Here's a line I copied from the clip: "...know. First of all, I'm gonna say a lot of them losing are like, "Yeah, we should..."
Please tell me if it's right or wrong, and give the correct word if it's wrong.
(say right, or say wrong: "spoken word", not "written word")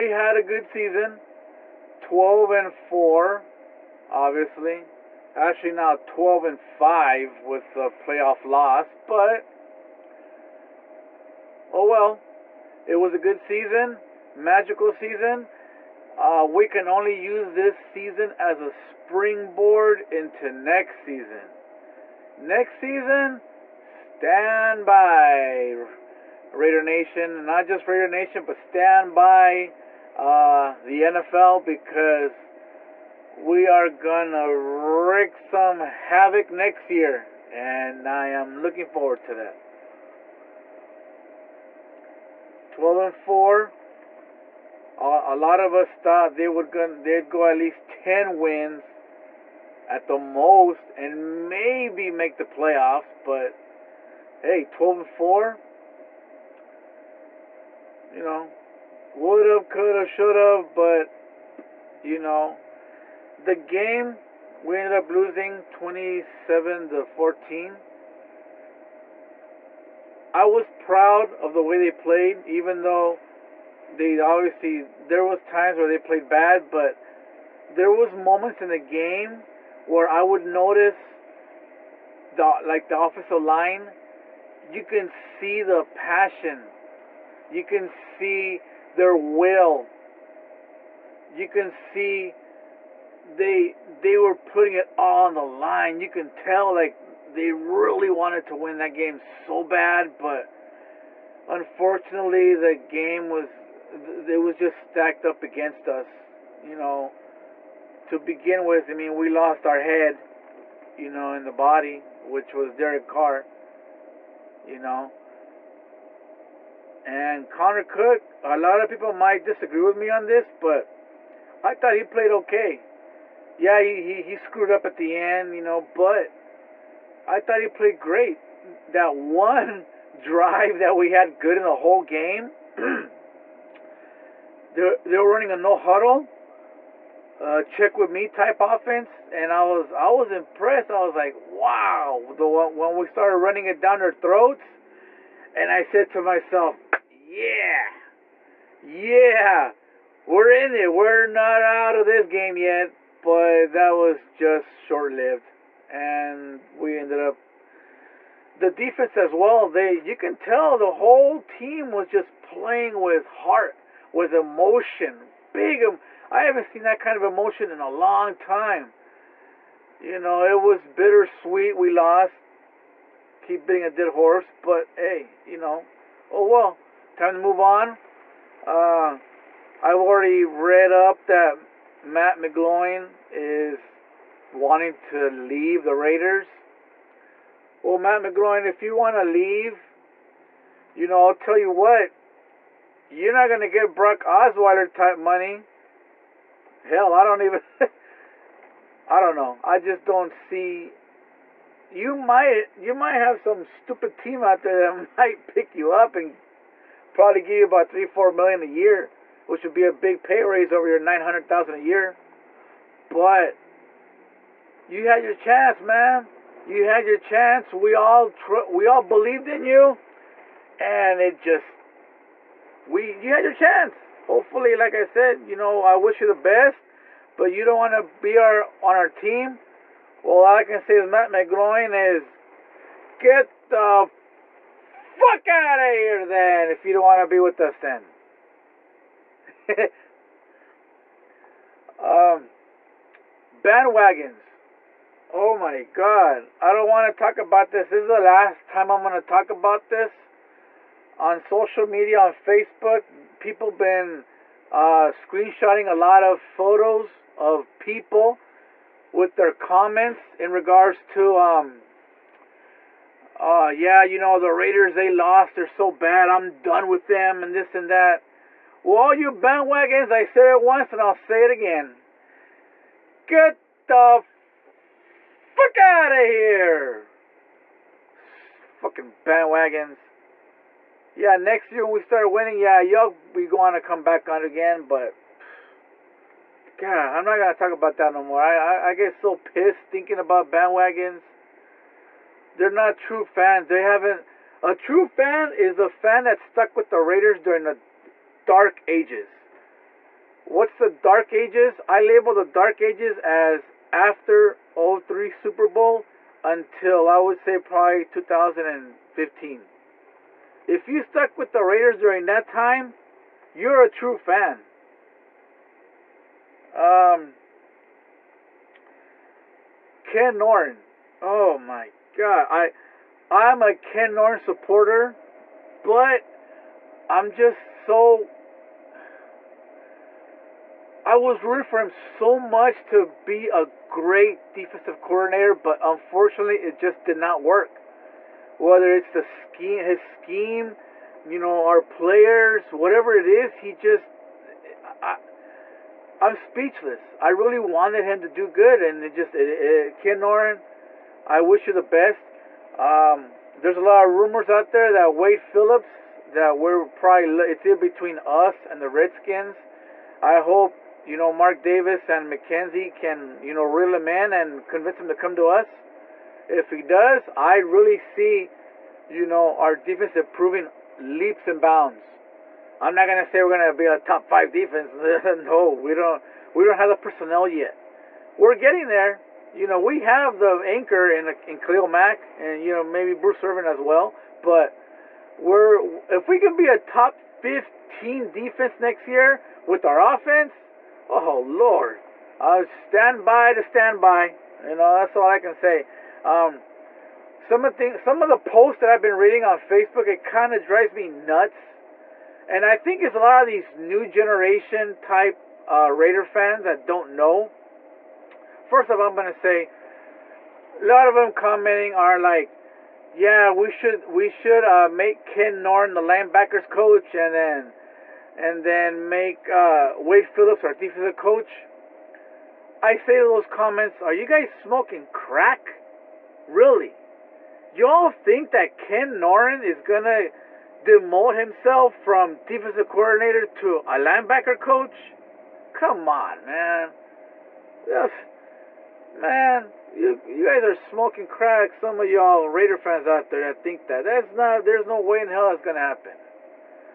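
wrong: "commenting", not "losing".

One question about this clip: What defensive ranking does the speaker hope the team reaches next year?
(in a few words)
top 15.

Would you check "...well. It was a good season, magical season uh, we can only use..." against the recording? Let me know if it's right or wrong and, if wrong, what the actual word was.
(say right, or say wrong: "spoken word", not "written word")
right.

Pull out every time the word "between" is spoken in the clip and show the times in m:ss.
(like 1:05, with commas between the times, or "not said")
5:57.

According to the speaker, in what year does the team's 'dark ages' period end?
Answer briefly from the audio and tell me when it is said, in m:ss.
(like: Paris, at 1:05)
2015, at 5:08.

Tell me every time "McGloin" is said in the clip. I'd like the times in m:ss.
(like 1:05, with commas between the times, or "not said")
3:02, 3:08, 3:51.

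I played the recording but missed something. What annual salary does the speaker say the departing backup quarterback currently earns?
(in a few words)
$900,000.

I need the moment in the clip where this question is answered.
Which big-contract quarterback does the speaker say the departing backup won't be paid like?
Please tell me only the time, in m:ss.
3:13.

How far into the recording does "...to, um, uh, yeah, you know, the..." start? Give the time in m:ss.
4:21.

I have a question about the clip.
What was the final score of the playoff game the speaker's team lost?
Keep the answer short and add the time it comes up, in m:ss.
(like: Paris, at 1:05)
27 to 14, at 1:05.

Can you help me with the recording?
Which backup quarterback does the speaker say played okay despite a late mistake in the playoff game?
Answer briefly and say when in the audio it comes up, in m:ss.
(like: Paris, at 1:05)
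Connor Cook, at 1:57.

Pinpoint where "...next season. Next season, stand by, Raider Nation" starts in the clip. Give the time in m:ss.
0:20.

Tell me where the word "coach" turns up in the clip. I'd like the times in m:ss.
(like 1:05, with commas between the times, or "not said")
6:56, 7:01, 7:14.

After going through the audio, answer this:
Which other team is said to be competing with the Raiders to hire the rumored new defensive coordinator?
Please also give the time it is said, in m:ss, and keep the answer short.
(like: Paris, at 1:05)
Redskins, at 5:58.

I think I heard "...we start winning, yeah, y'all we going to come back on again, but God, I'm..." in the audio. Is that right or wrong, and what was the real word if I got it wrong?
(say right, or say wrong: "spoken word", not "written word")
right.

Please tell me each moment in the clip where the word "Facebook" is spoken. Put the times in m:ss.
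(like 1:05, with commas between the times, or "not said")
4:12, 6:39.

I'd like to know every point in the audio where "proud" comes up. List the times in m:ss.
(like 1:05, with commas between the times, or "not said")
1:10.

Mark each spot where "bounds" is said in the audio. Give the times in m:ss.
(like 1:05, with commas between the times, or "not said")
6:11.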